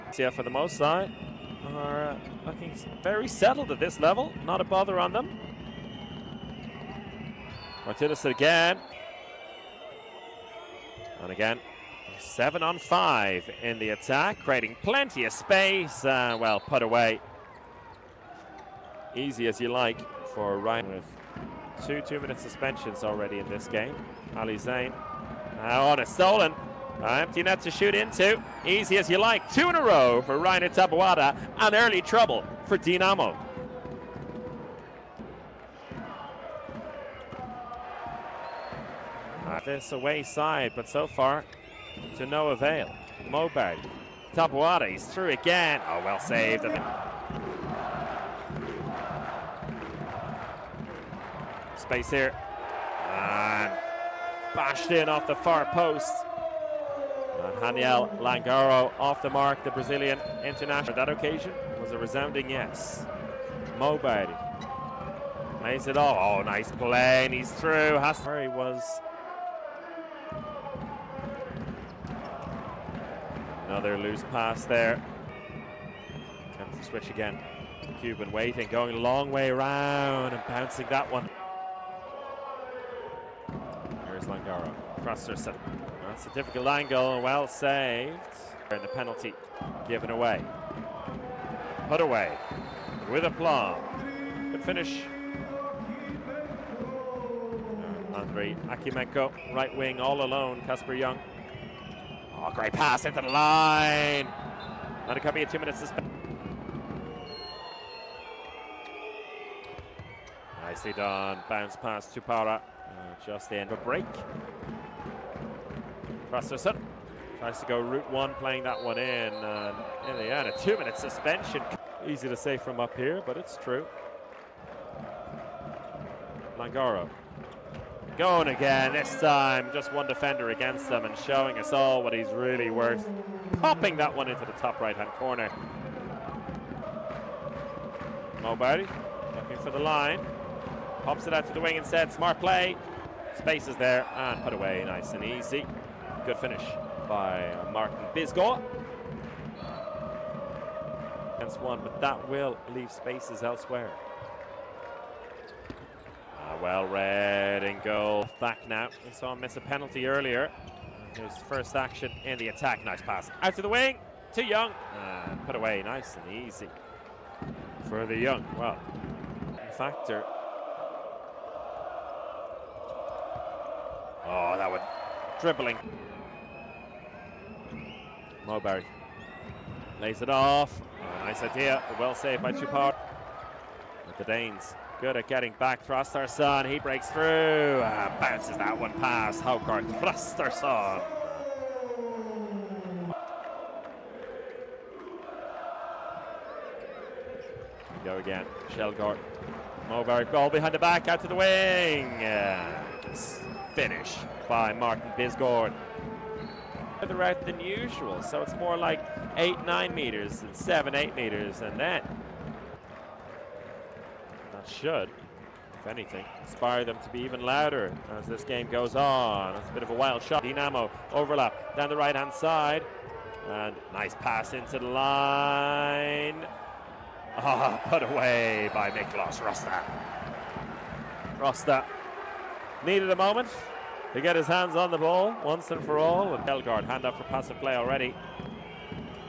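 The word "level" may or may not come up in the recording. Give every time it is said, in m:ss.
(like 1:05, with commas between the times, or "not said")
0:03.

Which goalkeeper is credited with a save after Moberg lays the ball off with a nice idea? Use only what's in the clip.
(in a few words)
Cupara.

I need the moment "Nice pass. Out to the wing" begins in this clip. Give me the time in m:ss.
2:42.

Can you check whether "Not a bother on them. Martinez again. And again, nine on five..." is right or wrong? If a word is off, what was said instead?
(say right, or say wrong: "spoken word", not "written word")
wrong: "seven", not "nine".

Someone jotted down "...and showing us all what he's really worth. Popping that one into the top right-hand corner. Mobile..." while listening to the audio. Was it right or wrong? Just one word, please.
right.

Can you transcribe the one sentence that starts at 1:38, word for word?
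Uh, Andrei Akimenko, right wing all alone, Casper Young.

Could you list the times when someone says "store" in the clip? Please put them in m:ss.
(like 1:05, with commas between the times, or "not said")
not said.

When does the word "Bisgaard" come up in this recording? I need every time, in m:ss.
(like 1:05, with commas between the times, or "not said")
2:28, 3:25.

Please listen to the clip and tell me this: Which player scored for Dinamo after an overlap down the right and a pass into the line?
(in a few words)
Miklos Rosta.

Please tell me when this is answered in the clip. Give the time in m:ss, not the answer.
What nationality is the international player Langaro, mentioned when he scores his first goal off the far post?
0:59.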